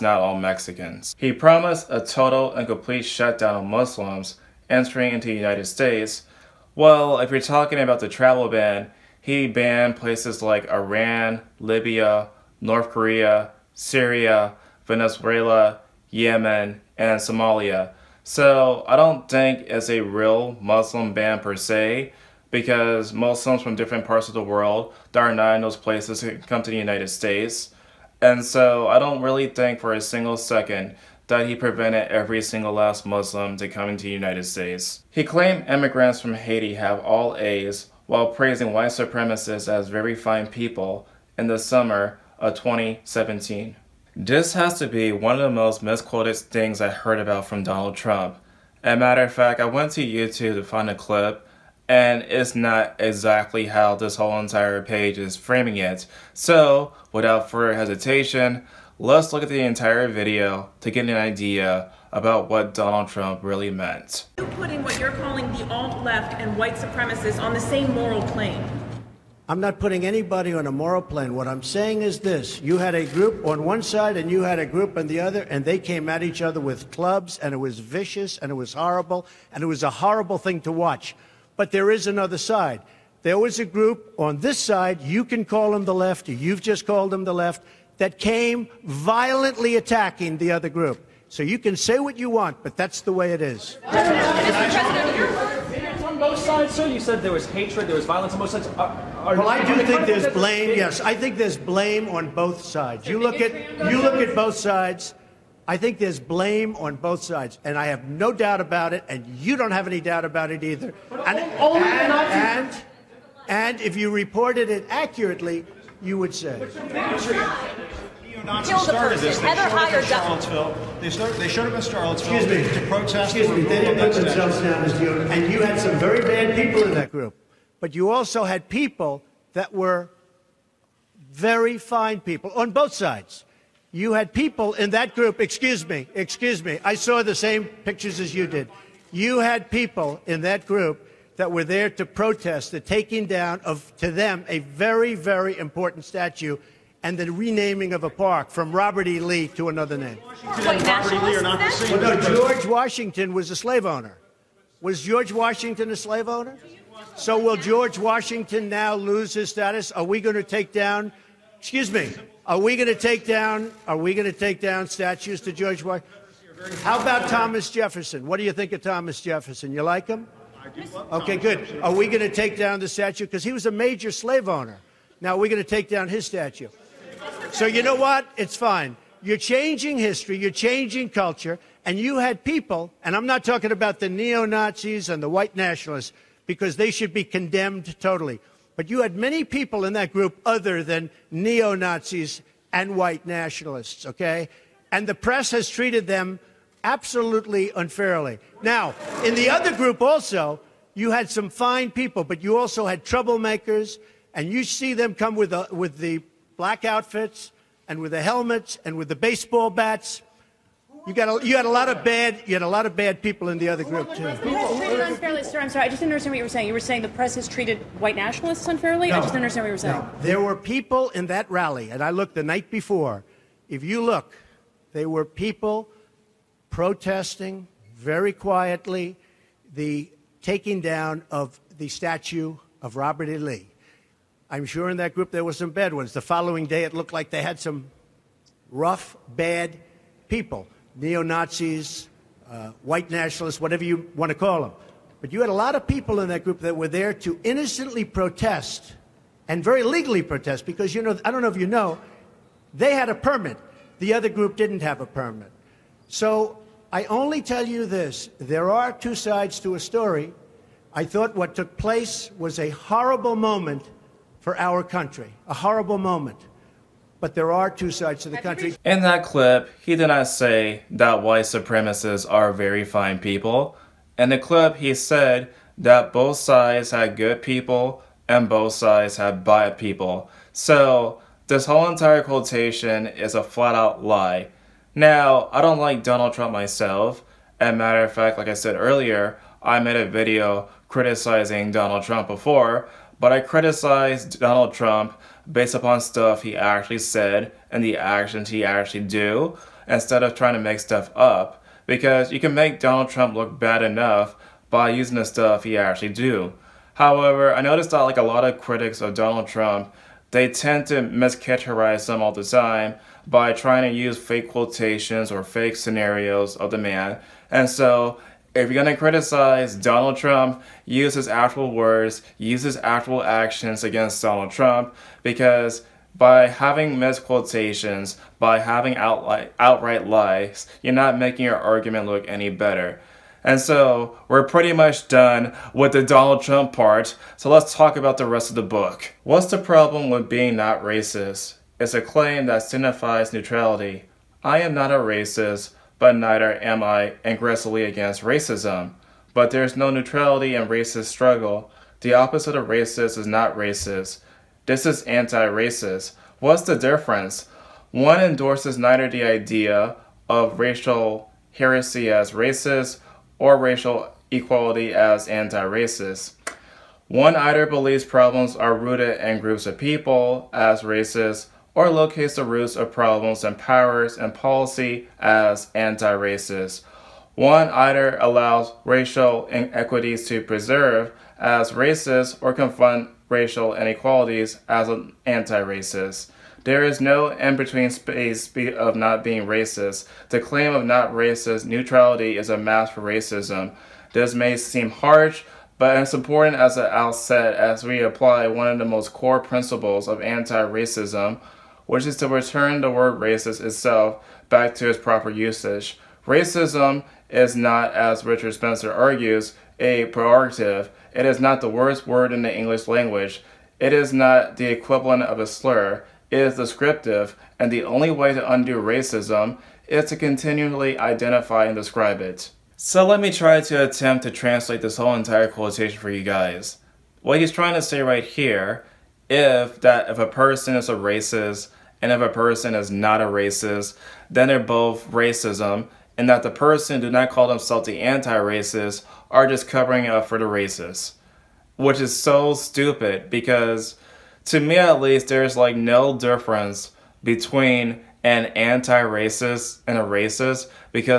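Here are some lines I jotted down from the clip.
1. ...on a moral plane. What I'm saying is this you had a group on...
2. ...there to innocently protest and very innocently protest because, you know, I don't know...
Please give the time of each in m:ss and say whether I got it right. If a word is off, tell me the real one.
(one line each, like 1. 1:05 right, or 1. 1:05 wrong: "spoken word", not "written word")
1. 1:10 right
2. 4:06 wrong: "legally", not "innocently".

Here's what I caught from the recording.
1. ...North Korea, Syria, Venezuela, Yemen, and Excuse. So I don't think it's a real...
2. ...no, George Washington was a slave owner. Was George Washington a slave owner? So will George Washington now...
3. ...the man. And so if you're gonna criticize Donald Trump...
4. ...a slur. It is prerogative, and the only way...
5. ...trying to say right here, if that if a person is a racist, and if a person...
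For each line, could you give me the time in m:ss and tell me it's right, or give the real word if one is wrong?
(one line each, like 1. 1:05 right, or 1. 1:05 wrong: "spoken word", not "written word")
1. 0:12 wrong: "Somalia", not "Excuse"
2. 2:32 right
3. 5:16 right
4. 6:55 wrong: "descriptive", not "prerogative"
5. 7:07 right.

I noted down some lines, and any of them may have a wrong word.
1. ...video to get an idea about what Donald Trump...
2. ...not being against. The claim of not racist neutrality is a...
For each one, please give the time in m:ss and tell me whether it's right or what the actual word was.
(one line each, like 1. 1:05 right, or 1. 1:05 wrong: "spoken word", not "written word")
1. 1:00 right
2. 6:28 wrong: "racist", not "against".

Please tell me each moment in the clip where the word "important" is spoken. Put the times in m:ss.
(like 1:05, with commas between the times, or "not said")
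2:25, 6:36.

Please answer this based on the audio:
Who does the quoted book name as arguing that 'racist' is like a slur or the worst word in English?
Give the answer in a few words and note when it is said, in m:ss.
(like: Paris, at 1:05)
Richard Spencer, at 6:48.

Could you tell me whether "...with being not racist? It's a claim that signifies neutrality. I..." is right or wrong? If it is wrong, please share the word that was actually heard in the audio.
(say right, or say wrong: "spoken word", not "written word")
right.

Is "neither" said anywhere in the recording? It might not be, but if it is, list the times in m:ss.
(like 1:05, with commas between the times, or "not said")
5:46, 5:58.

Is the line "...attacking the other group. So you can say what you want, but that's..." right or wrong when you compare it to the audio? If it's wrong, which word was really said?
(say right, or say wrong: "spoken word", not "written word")
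right.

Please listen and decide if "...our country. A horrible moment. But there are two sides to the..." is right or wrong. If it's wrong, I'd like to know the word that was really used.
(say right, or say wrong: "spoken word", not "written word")
right.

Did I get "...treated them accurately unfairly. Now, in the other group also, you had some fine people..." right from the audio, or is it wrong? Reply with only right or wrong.
wrong.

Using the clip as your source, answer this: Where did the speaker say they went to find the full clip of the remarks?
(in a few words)
YouTube.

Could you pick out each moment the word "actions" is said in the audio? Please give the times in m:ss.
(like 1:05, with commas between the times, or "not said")
4:57, 5:23.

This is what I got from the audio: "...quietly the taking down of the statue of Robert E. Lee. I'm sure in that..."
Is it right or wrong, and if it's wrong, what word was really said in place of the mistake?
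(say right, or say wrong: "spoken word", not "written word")
right.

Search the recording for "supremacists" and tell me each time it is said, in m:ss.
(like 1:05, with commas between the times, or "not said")
0:38, 1:06, 4:31.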